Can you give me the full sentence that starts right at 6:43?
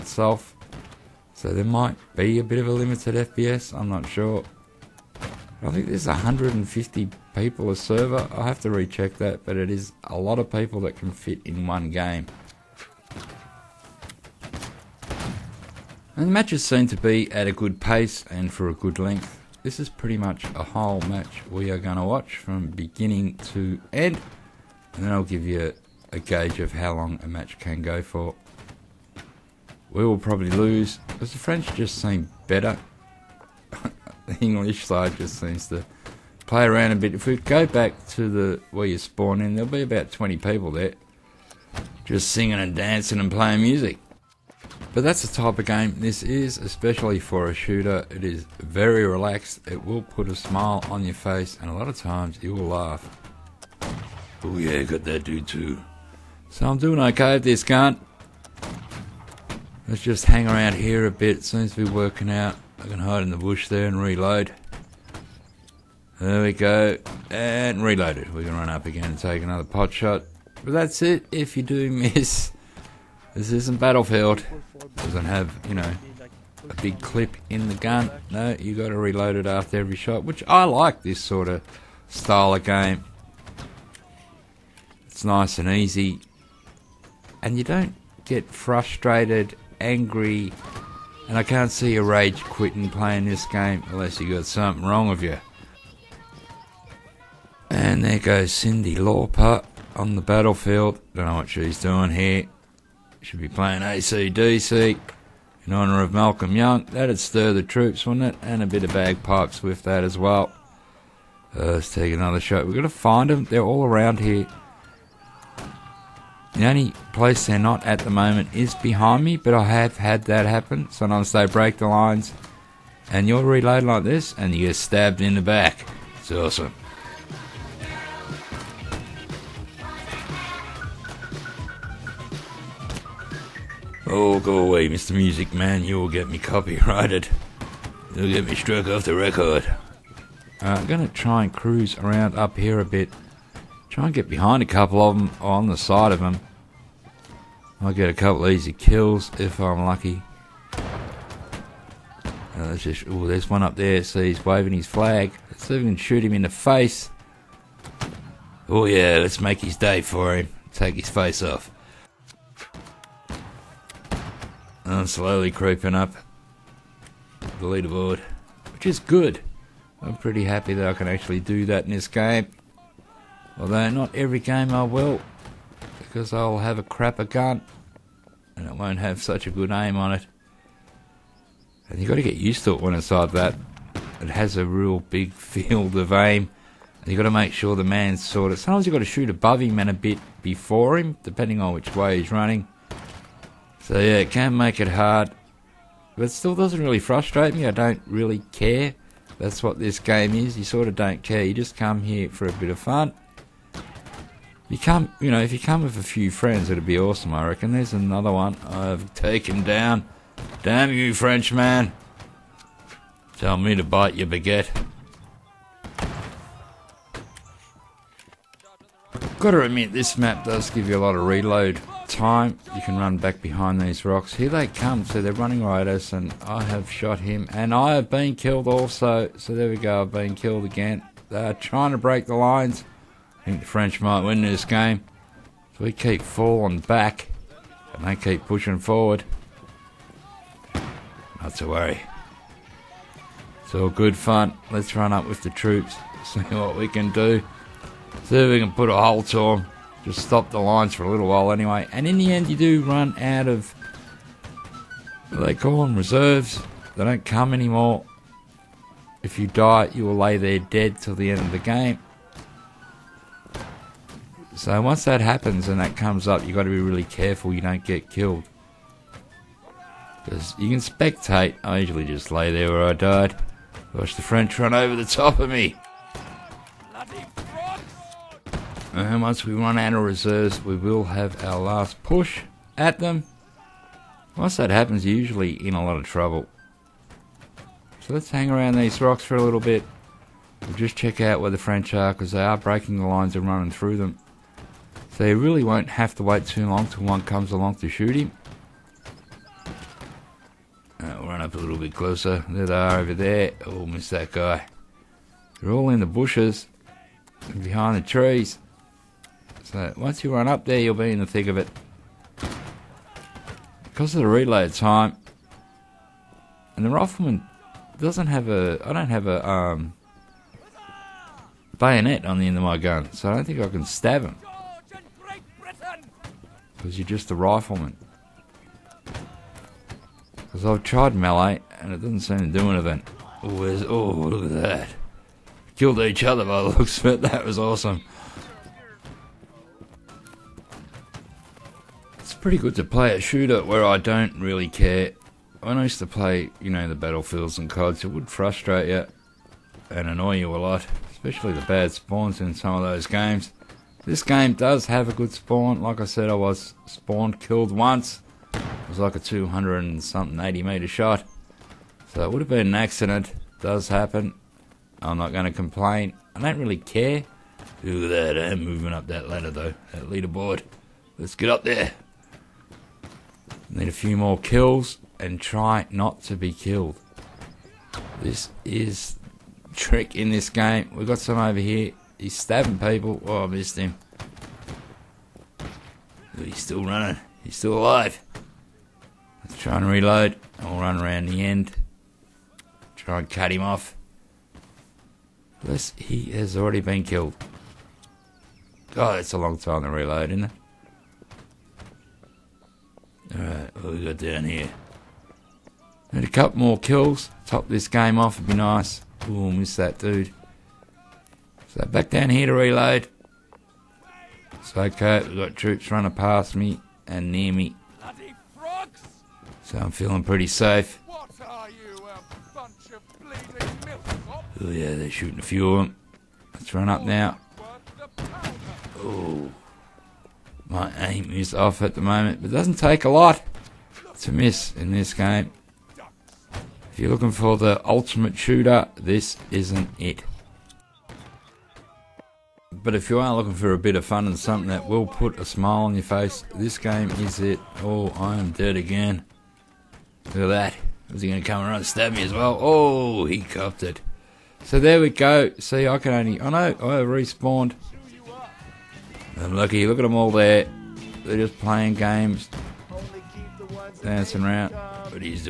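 Alright, what we got down here?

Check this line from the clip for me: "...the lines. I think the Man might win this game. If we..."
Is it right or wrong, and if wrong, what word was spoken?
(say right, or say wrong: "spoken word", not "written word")
wrong: "French", not "Man".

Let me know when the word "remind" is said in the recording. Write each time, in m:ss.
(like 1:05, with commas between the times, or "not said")
not said.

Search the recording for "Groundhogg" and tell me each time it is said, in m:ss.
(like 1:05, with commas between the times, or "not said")
not said.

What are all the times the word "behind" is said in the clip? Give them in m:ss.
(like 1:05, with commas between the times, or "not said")
1:58, 2:24, 3:43, 5:07.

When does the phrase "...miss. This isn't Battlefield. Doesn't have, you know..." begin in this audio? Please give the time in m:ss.
1:11.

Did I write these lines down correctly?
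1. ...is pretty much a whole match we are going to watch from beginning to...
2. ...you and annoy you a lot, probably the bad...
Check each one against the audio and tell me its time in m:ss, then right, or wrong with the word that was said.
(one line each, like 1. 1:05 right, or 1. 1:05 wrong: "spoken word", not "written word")
1. 0:19 right
2. 5:48 wrong: "especially", not "probably".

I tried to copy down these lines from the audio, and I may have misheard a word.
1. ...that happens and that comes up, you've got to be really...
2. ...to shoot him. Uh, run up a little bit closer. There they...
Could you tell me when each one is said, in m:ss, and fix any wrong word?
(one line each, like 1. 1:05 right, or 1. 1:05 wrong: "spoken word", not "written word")
1. 4:25 right
2. 4:57 right.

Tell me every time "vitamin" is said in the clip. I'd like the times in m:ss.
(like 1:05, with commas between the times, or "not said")
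not said.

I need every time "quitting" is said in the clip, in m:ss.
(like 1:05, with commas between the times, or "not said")
1:32.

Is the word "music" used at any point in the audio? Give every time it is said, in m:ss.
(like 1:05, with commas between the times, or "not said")
0:43, 2:15.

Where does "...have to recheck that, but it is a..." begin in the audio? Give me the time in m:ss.
0:08.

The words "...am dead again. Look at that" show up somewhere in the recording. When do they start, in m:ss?
7:28.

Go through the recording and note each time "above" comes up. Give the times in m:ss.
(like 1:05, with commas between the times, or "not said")
3:09.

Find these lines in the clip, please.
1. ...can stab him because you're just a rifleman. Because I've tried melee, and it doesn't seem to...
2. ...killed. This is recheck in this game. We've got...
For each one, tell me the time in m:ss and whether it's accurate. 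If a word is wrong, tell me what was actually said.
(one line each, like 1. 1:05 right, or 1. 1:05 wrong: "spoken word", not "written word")
1. 5:23 right
2. 6:16 wrong: "trick", not "recheck".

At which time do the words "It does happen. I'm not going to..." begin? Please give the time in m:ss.
6:03.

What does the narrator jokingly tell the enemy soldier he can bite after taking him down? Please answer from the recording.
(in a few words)
your baguette.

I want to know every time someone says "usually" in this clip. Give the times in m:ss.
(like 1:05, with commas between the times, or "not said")
4:31, 4:45.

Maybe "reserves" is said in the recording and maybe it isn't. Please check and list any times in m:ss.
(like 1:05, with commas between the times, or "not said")
4:15, 4:40.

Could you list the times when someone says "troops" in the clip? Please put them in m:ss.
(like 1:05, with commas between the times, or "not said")
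1:47, 4:05, 6:55.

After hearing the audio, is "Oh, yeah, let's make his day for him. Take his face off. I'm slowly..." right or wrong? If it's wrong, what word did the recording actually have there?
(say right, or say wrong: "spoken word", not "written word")
right.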